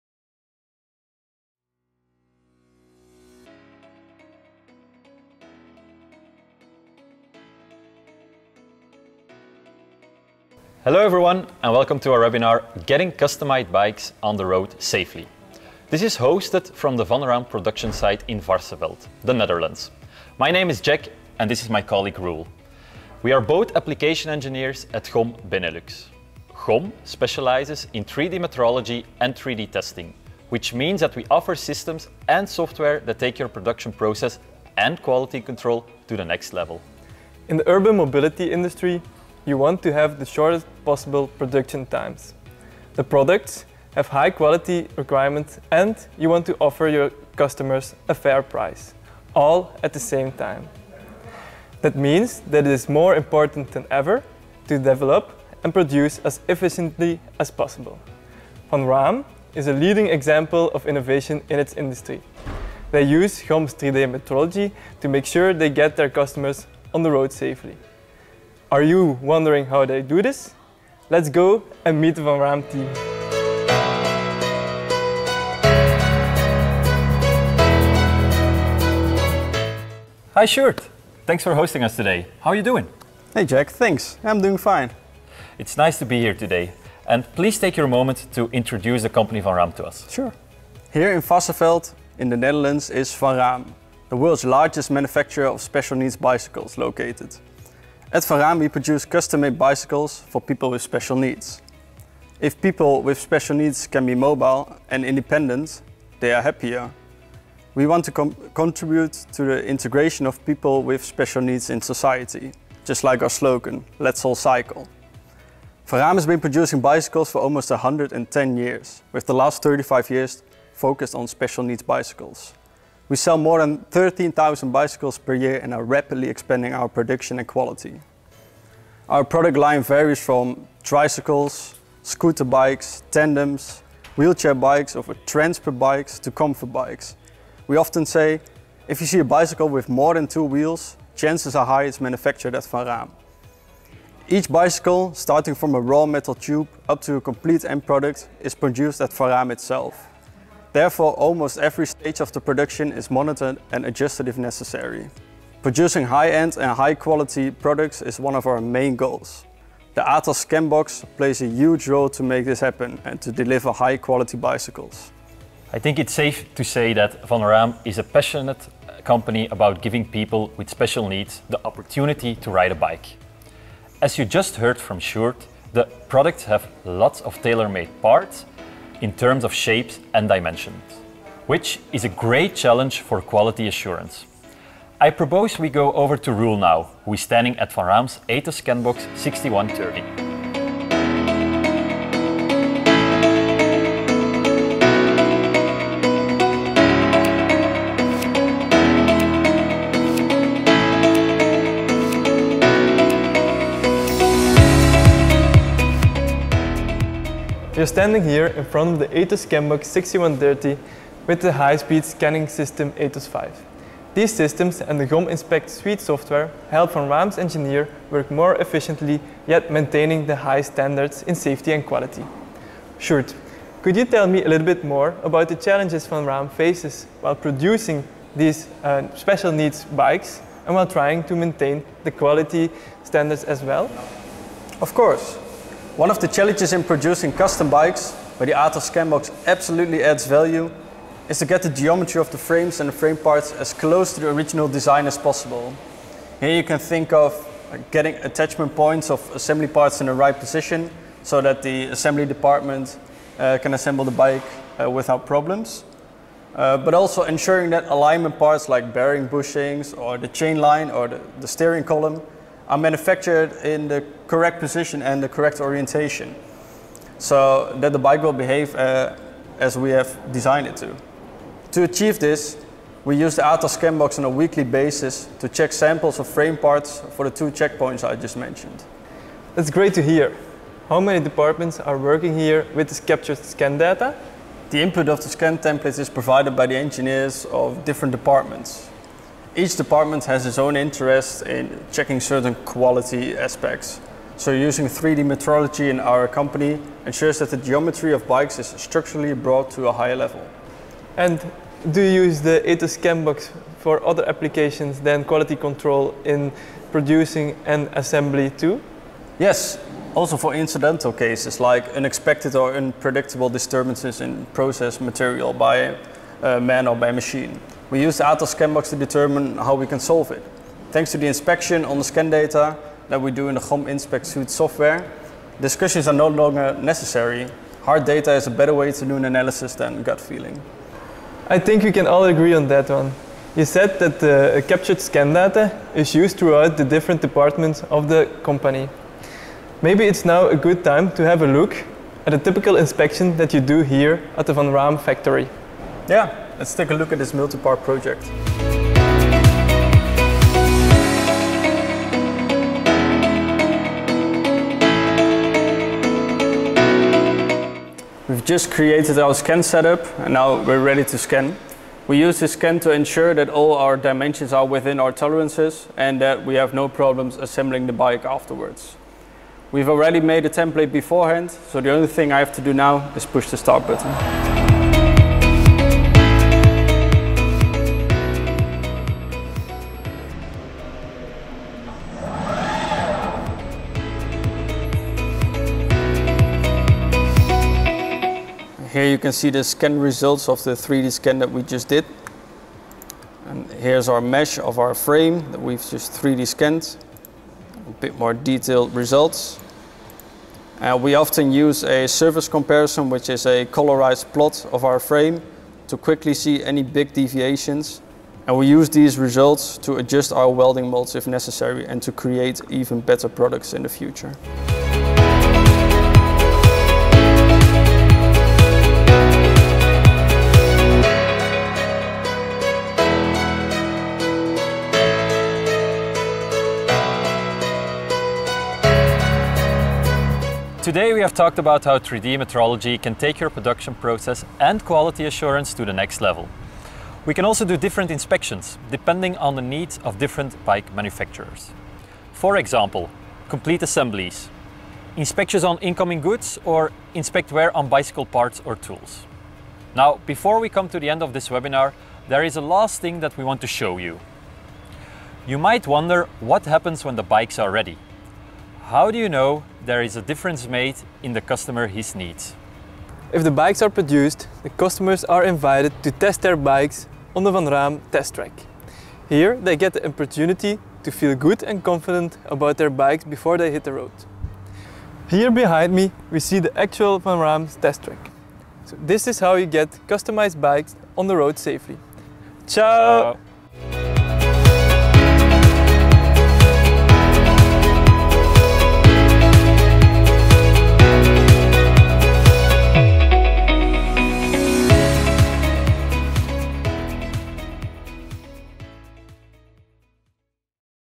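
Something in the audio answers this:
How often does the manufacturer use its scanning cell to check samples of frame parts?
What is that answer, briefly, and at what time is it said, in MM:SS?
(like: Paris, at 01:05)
weekly, at 04:34.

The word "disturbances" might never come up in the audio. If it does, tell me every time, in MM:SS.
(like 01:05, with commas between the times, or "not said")
05:13.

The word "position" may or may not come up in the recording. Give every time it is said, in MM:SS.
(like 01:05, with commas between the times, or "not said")
04:10, 04:24.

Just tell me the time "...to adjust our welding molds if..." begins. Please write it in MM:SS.
06:49.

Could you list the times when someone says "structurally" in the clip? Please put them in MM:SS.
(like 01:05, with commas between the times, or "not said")
04:58.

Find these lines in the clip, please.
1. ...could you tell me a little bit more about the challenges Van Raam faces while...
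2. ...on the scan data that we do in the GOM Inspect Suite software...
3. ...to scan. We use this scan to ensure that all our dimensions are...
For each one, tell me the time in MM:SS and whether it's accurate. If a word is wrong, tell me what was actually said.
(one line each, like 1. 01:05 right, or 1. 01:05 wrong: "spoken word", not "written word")
1. 03:43 right
2. 05:21 right
3. 06:01 right.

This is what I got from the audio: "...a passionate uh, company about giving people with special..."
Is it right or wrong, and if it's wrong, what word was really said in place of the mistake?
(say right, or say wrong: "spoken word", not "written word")
right.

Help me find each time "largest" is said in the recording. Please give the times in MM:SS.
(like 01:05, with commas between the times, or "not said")
01:34.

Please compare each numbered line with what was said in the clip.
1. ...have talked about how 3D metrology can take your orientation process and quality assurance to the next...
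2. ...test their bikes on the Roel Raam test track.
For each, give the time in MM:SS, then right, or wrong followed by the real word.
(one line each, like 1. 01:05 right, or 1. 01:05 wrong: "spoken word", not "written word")
1. 07:11 wrong: "production", not "orientation"
2. 07:46 wrong: "Van", not "Roel".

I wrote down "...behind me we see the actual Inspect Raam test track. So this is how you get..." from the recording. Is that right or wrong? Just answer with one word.
wrong.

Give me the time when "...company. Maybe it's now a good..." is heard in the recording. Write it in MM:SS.
05:38.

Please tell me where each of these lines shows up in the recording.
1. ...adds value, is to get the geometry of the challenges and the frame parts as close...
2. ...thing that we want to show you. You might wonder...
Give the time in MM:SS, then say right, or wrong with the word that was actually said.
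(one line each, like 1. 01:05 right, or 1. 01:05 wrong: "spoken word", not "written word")
1. 04:00 wrong: "frames", not "challenges"
2. 07:32 right.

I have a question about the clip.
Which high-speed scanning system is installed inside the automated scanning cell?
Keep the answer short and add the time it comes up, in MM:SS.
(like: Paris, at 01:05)
ATOS 5, at 03:32.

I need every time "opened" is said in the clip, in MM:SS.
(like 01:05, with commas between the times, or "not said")
not said.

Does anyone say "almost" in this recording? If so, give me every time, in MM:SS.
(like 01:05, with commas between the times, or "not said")
01:57, 02:31.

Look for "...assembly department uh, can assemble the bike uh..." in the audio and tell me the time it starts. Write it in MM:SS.
04:11.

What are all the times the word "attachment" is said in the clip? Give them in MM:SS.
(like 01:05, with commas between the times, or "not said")
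04:08.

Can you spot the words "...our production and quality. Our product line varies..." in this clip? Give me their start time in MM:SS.
02:06.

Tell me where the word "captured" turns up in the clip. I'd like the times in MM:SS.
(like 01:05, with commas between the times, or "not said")
04:43, 05:34.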